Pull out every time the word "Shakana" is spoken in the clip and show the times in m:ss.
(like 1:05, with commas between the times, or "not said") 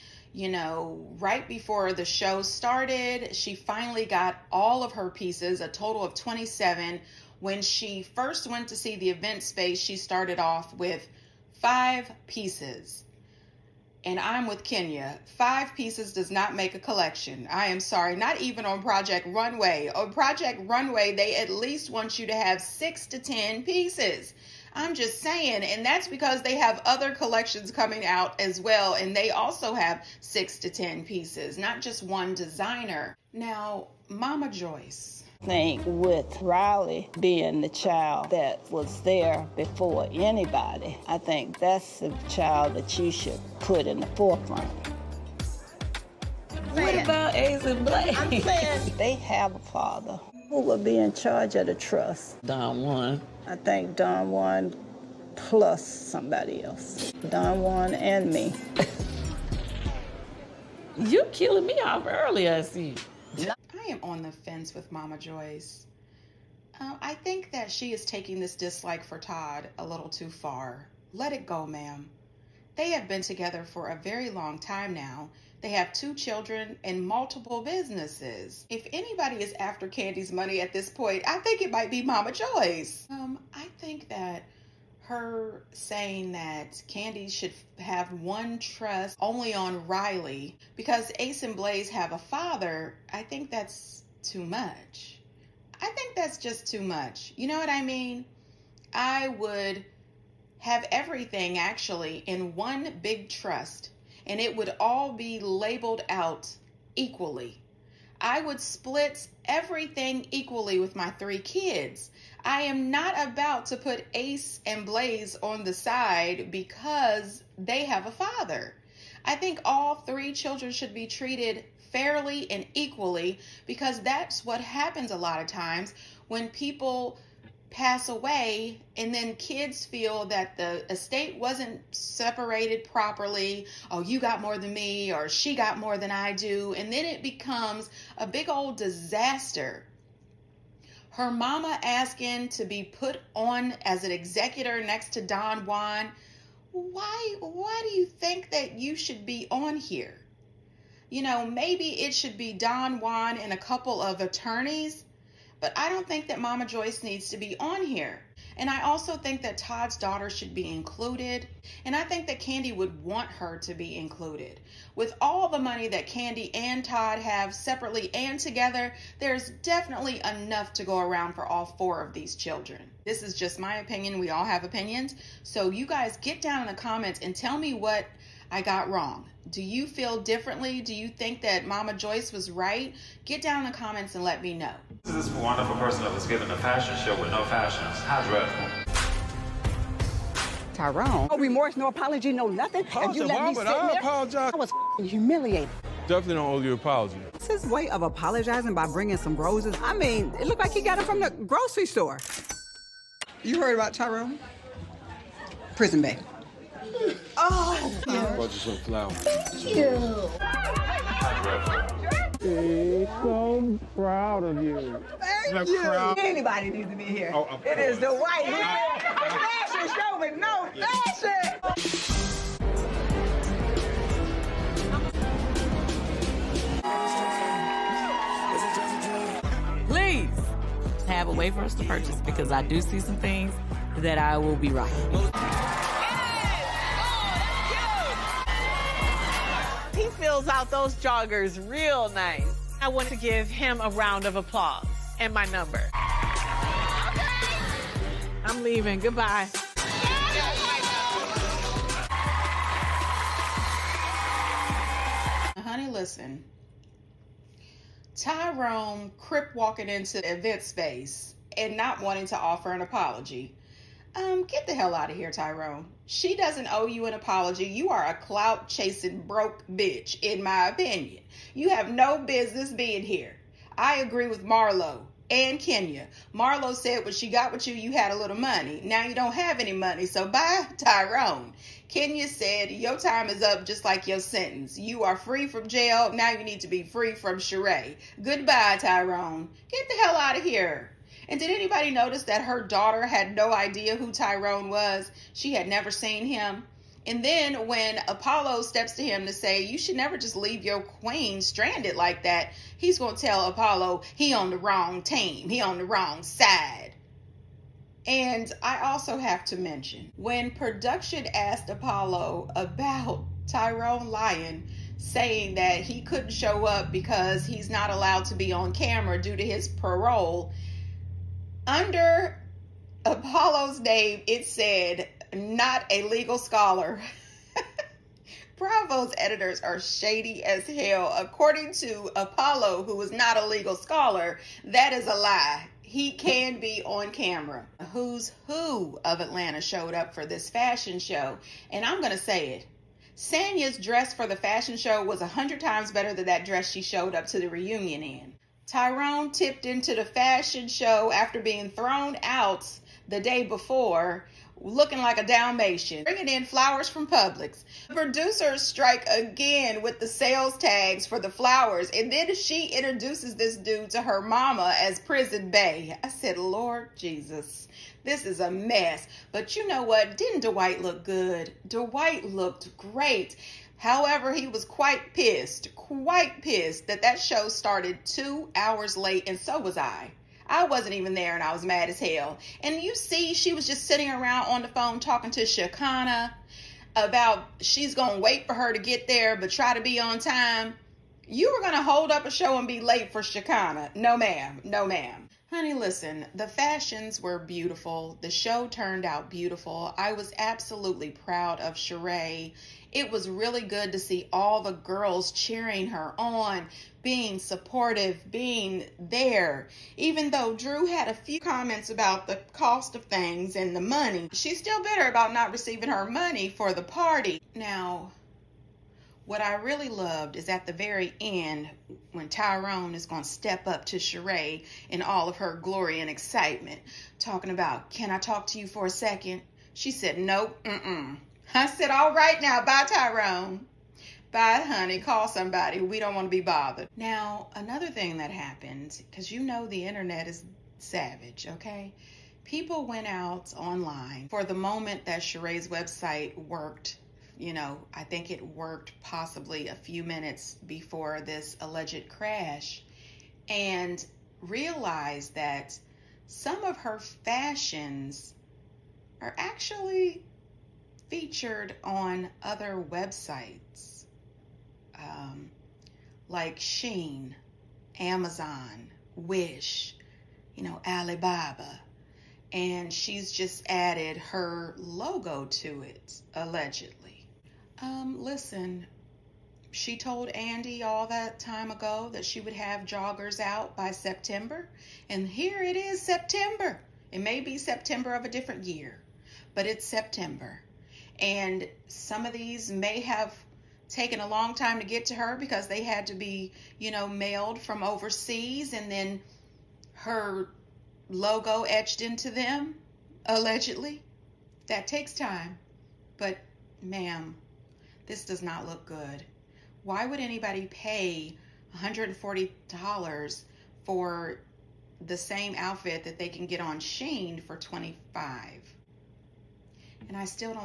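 6:25, 6:33.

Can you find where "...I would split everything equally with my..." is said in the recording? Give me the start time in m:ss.
1:48.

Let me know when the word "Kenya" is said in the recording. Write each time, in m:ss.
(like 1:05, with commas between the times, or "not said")
0:14, 4:35, 4:41.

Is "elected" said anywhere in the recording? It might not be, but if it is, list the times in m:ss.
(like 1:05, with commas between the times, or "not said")
not said.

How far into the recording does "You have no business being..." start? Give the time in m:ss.
4:31.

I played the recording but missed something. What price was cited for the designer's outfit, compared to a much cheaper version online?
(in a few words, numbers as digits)
$140.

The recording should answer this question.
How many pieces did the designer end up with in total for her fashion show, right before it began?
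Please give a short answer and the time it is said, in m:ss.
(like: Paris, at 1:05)
27, at 0:05.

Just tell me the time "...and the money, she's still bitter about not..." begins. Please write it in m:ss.
6:53.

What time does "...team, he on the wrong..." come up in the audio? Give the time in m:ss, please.
5:05.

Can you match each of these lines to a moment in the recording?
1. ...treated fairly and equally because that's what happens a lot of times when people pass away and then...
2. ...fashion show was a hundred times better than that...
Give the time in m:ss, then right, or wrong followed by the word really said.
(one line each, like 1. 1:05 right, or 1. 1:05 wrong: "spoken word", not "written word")
1. 2:01 right
2. 5:44 right.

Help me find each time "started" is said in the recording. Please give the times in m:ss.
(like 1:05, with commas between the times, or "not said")
0:02, 0:09, 6:17.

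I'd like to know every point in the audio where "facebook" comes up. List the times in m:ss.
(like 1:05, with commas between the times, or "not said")
not said.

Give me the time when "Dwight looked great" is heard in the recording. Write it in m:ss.
6:11.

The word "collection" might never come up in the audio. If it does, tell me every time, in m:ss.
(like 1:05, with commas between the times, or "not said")
0:16, 0:27.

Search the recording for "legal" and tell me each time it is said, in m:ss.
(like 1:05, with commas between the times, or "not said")
5:26, 5:33.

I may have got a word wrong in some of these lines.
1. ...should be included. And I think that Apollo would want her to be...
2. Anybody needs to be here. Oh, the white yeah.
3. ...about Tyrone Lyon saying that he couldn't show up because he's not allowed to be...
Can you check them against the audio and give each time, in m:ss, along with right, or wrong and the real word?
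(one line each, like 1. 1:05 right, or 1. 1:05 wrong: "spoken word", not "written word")
1. 2:40 wrong: "Kandi", not "Apollo"
2. 3:36 right
3. 5:12 right.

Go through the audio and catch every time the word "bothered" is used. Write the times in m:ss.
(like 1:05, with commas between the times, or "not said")
7:16.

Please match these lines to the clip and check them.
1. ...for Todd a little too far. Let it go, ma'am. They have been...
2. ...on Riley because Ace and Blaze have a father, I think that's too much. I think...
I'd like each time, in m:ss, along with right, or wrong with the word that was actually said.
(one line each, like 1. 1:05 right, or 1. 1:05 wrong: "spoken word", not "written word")
1. 1:09 right
2. 1:29 right.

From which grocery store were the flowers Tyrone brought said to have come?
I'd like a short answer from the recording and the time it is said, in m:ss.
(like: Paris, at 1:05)
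Publix, at 5:57.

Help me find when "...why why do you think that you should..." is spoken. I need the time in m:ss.
2:26.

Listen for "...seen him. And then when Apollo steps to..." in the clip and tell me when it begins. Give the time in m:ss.
4:55.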